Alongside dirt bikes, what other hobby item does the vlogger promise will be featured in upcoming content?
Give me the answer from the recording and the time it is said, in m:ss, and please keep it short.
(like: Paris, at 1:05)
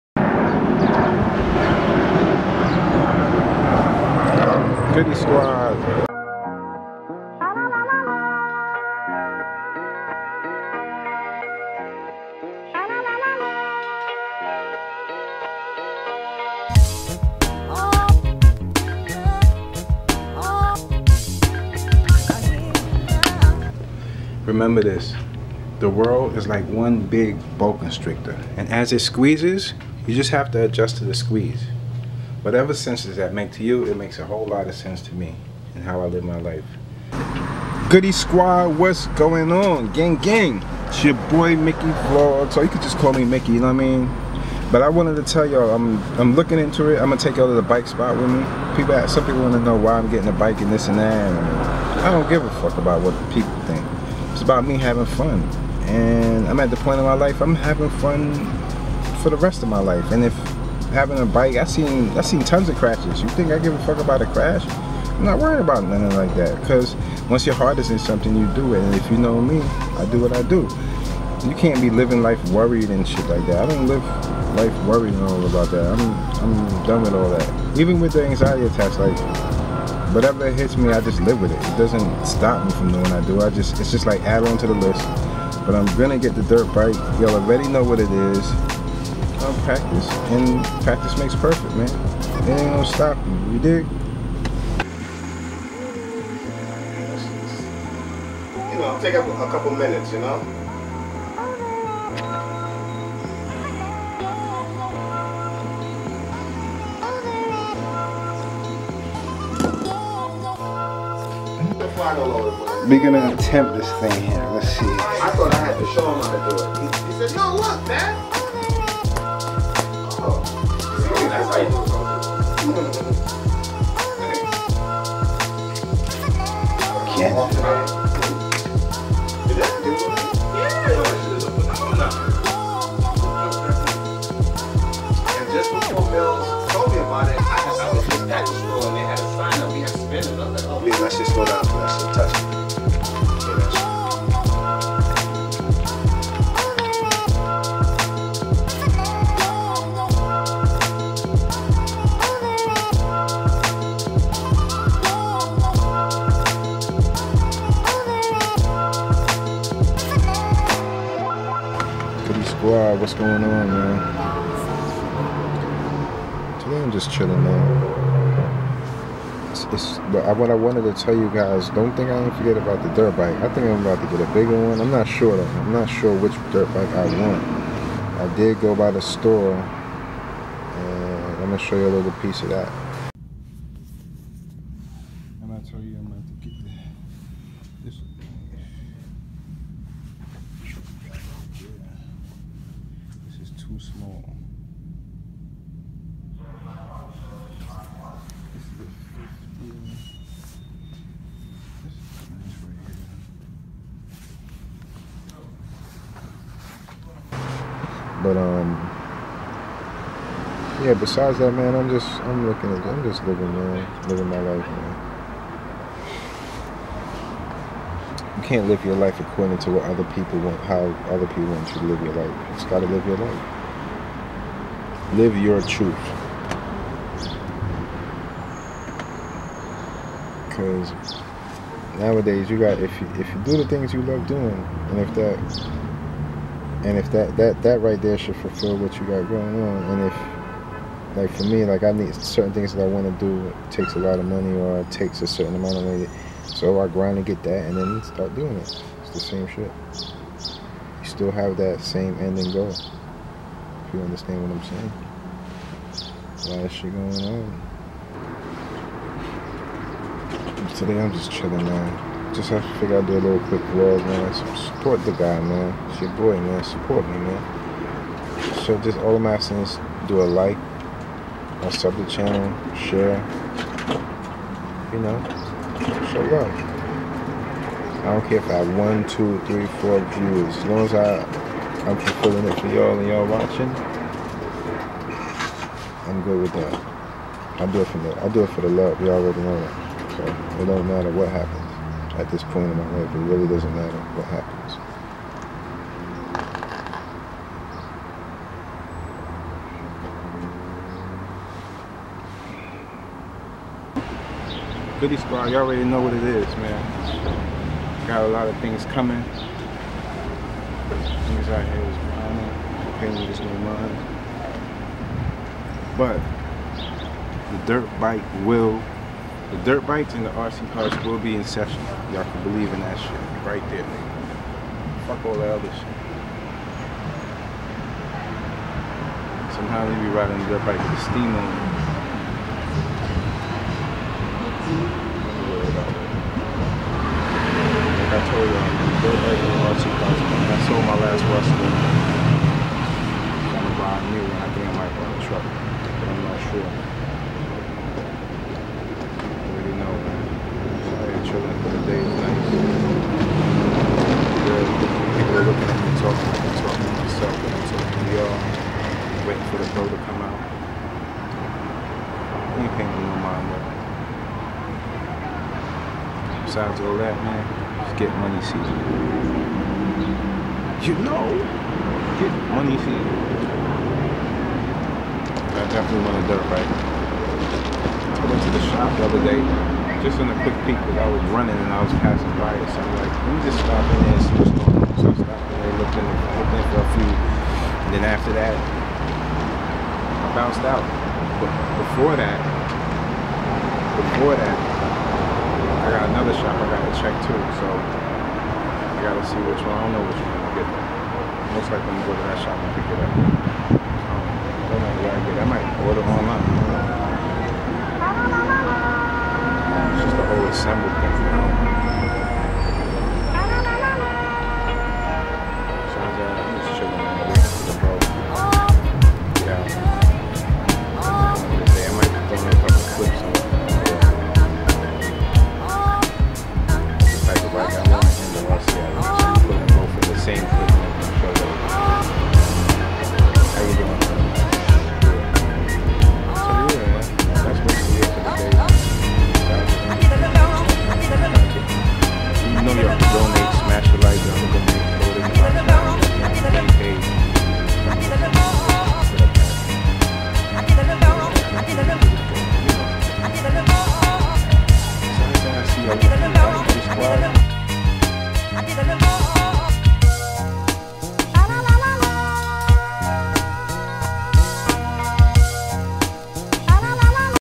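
RC cars, at 5:20.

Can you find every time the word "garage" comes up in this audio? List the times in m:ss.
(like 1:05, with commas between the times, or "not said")
not said.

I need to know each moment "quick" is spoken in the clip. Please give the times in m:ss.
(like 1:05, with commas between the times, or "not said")
4:23, 6:20.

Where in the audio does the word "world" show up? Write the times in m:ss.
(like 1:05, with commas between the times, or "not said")
0:25.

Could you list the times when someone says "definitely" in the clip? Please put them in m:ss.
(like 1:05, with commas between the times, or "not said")
6:15.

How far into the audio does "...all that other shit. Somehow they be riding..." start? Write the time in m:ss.
5:25.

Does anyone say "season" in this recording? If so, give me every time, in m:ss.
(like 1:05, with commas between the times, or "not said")
6:08, 6:12.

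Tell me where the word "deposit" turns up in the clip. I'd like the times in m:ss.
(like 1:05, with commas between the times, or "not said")
not said.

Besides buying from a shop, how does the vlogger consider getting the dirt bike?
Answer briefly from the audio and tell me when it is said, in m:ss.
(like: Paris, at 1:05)
order online, at 6:45.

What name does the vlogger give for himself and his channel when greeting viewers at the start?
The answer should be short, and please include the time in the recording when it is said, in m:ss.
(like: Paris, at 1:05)
Mickey Vlog, at 0:41.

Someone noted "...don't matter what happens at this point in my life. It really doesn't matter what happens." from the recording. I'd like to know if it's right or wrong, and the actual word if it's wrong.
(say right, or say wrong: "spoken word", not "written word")
right.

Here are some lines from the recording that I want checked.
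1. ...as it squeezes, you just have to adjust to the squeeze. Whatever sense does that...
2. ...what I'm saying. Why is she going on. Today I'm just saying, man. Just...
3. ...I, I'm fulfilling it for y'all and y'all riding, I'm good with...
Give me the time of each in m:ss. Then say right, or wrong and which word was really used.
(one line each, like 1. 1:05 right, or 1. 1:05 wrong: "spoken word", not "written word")
1. 0:28 right
2. 4:14 wrong: "chilling", not "saying"
3. 4:40 wrong: "watching", not "riding".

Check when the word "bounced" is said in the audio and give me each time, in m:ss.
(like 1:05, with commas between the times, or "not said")
6:30.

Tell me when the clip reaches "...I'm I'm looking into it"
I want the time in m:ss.
0:45.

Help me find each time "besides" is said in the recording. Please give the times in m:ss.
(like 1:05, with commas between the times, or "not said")
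3:30, 6:06.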